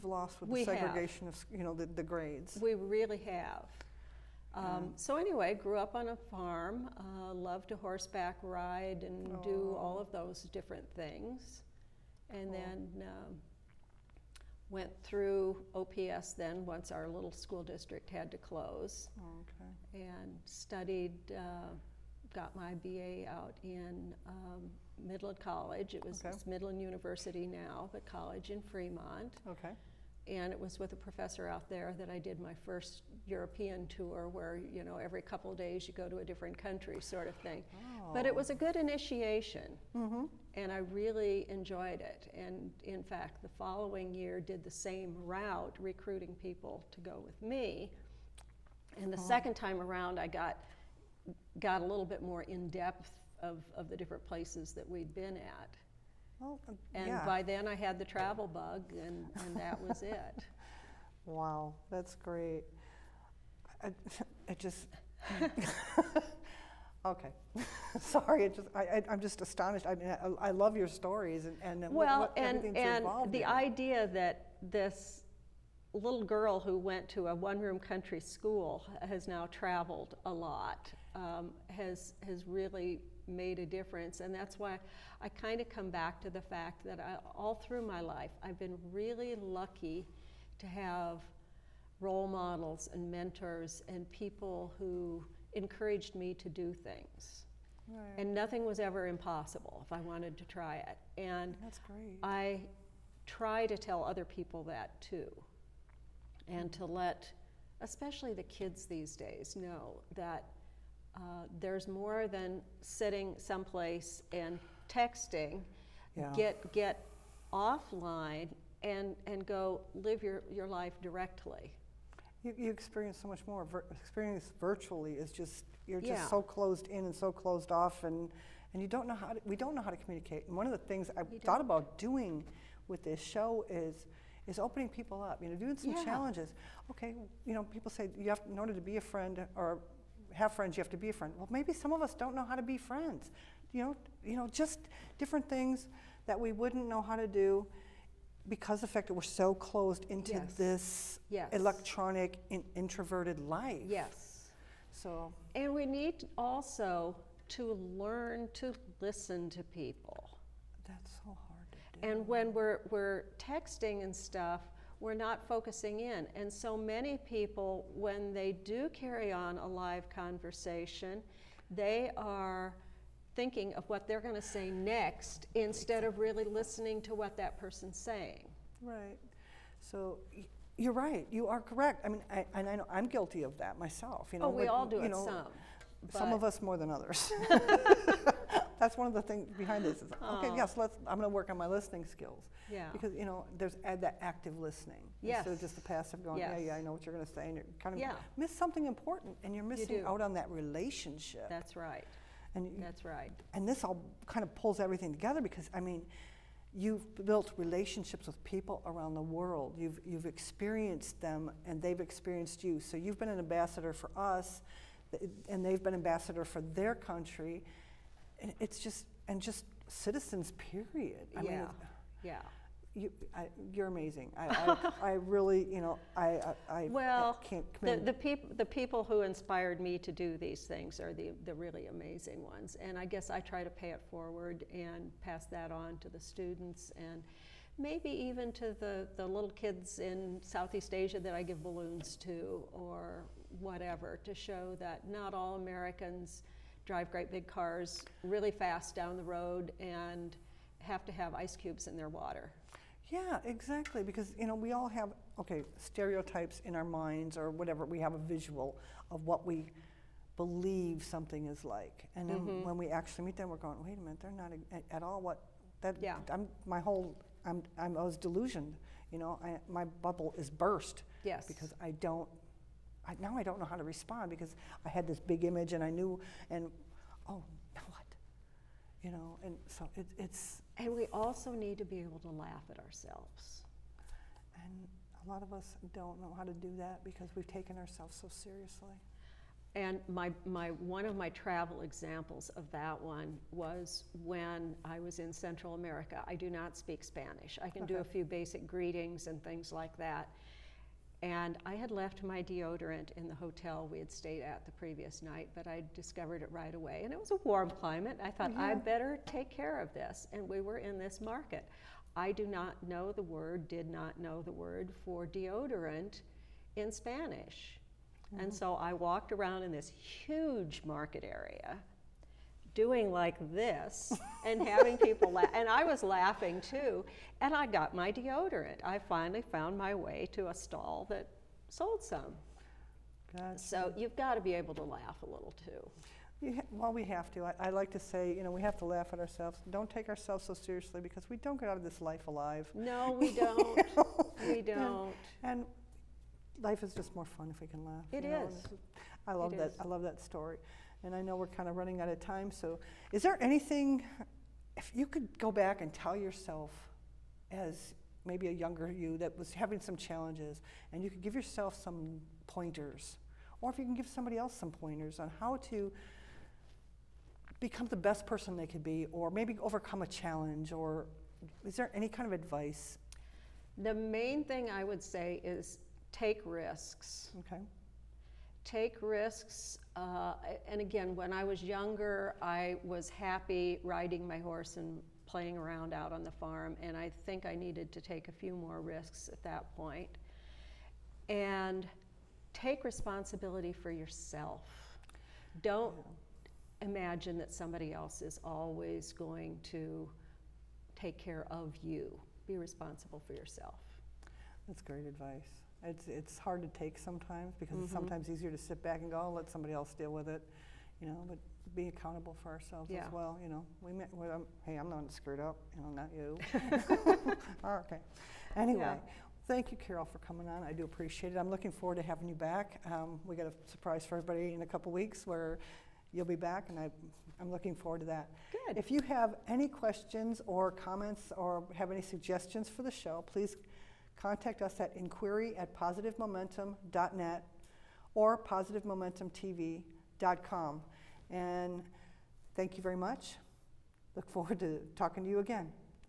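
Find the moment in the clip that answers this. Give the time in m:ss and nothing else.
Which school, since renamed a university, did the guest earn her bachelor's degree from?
0:25.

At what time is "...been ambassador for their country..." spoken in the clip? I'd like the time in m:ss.
3:35.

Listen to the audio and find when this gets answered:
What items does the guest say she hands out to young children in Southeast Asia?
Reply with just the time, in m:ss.
4:01.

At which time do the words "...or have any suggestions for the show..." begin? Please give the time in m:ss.
7:11.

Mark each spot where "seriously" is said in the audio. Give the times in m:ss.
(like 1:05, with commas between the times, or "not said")
4:48, 5:40.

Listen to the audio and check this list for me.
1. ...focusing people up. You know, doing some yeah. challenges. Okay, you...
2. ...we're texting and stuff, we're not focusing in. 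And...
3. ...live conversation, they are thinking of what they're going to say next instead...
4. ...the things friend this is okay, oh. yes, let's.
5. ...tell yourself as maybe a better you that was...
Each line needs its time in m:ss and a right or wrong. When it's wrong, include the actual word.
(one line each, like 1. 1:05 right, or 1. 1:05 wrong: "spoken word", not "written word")
1. 2:14 wrong: "opening", not "focusing"
2. 2:42 right
3. 2:49 right
4. 3:09 wrong: "behind", not "friend"
5. 5:55 wrong: "younger", not "better".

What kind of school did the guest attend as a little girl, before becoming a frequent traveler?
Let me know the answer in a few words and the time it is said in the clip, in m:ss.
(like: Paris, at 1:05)
One-room country school, at 1:17.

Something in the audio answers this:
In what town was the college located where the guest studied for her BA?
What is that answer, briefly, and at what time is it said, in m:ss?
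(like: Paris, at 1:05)
Fremont, at 0:28.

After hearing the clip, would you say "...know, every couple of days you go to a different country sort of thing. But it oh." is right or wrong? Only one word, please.
right.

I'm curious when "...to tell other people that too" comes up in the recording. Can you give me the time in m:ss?
1:43.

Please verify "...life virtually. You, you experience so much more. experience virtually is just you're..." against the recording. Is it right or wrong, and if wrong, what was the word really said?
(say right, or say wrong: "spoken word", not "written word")
wrong: "directly", not "virtually".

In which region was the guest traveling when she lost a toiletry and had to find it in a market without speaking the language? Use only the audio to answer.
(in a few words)
Central America.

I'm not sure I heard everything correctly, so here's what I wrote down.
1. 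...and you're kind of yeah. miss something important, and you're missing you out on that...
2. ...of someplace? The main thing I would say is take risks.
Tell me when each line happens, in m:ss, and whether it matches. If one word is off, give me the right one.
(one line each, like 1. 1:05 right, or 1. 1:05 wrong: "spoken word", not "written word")
1. 3:17 right
2. 6:12 wrong: "advice", not "someplace".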